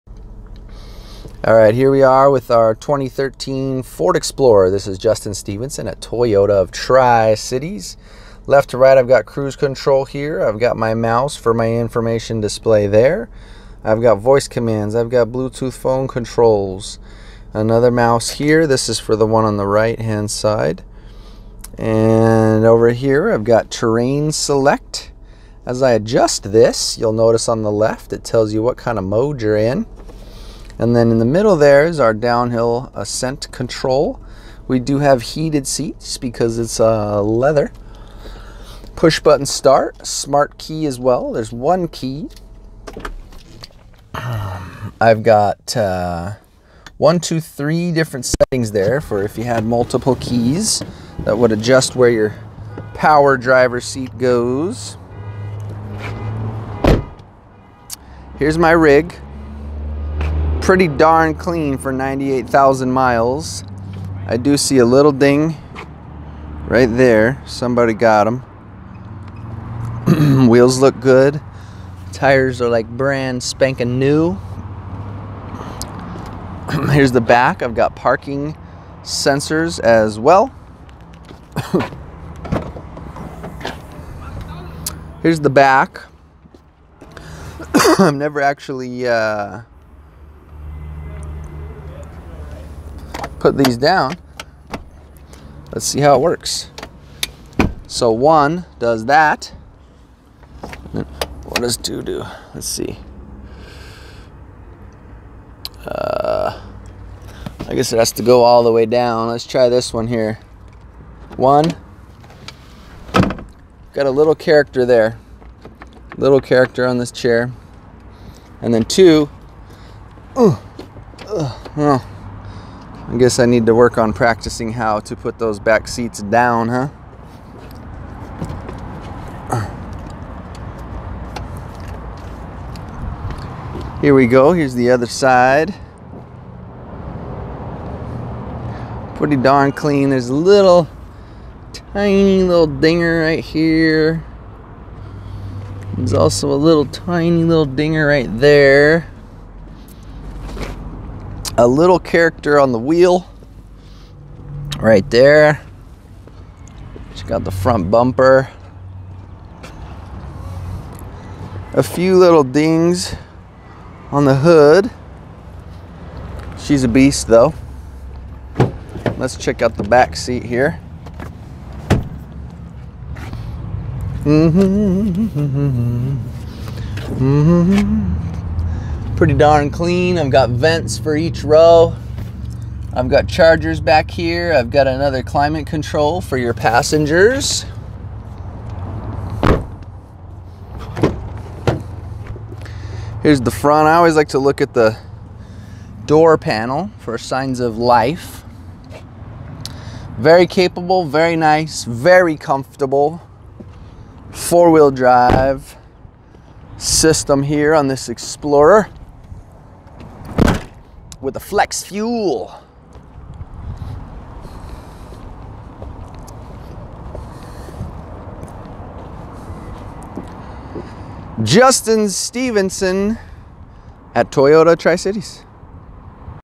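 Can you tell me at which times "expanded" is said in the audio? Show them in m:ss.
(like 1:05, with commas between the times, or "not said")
not said.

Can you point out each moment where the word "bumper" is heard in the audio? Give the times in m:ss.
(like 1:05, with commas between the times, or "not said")
2:37.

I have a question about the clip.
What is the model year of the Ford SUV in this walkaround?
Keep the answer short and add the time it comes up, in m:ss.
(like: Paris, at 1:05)
2013, at 0:02.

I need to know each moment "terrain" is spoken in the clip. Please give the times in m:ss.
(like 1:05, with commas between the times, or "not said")
0:23.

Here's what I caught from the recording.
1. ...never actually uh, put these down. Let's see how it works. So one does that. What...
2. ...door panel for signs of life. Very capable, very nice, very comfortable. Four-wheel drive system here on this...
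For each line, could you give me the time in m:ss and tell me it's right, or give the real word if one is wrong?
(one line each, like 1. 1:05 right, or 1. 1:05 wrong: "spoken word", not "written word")
1. 1:28 right
2. 3:16 right.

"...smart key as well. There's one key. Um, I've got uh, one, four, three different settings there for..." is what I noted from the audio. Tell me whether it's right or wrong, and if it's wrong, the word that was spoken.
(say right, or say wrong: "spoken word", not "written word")
wrong: "two", not "four".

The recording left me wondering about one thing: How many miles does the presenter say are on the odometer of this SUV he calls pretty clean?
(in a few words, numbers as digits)
98,000.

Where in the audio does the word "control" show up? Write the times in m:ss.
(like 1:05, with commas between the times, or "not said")
0:09, 0:16, 0:33, 3:05.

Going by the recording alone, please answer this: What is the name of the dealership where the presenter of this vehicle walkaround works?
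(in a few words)
Toyota of Tri-Cities.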